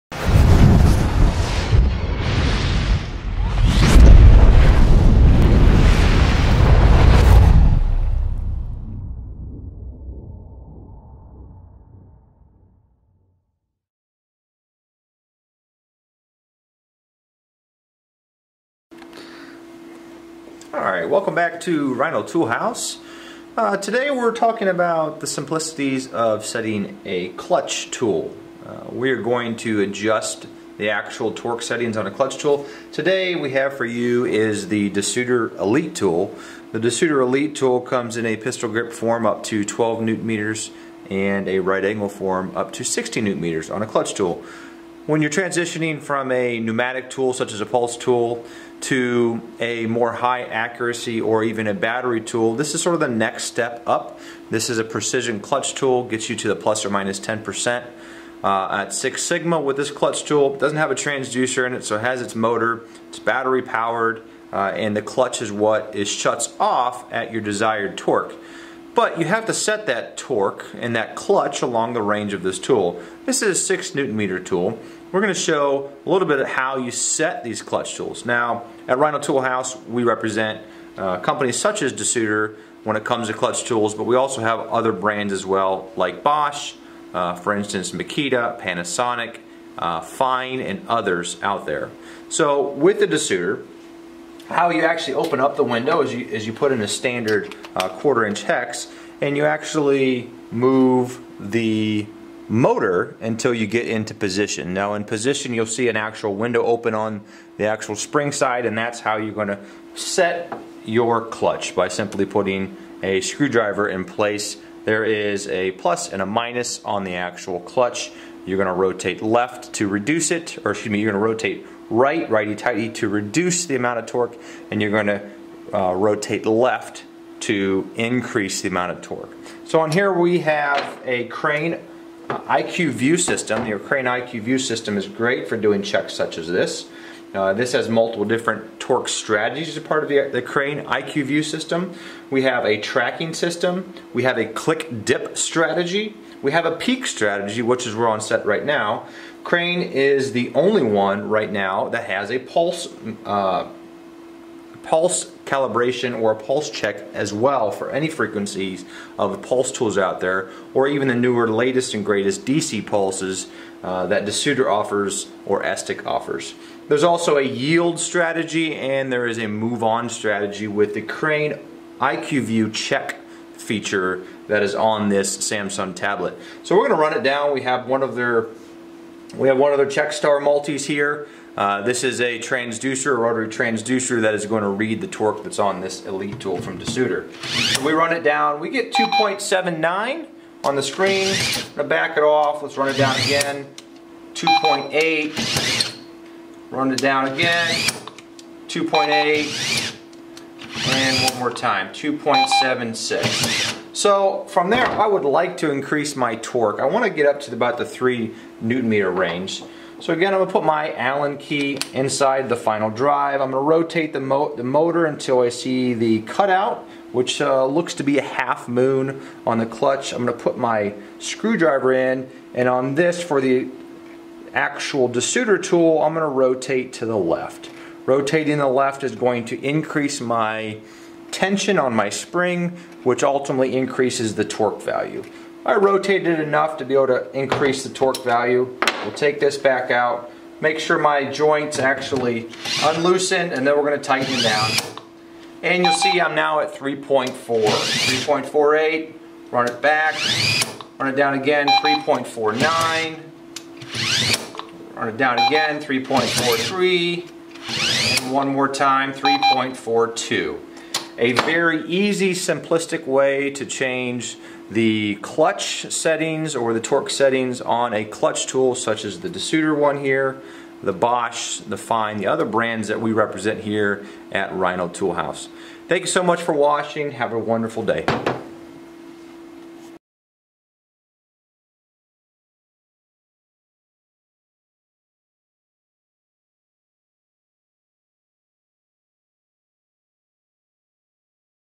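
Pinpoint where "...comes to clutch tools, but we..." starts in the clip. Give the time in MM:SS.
01:23.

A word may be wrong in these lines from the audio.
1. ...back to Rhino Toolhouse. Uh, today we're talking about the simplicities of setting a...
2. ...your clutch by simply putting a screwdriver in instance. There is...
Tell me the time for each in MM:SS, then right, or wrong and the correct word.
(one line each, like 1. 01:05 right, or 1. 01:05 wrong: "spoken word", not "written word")
1. 00:21 right
2. 01:50 wrong: "place", not "instance".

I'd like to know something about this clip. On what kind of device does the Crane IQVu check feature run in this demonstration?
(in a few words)
Samsung tablet.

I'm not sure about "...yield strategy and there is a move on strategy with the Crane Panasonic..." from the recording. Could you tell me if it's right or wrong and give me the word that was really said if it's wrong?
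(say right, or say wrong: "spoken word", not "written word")
wrong: "IQVu", not "Panasonic".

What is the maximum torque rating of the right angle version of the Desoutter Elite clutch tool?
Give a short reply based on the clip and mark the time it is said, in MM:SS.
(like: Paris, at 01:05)
60 newton meters, at 00:42.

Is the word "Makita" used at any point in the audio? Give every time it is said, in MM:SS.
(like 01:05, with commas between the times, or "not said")
01:27.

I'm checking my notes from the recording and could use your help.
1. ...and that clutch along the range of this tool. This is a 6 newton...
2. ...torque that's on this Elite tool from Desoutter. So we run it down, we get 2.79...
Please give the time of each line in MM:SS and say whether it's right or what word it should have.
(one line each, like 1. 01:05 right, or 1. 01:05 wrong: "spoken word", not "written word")
1. 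01:10 right
2. 03:05 right.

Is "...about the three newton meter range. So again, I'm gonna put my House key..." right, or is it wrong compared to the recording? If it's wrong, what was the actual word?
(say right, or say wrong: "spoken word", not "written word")
wrong: "Allen", not "House".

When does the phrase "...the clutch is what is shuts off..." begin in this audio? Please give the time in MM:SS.
01:04.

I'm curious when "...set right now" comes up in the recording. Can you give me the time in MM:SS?
02:28.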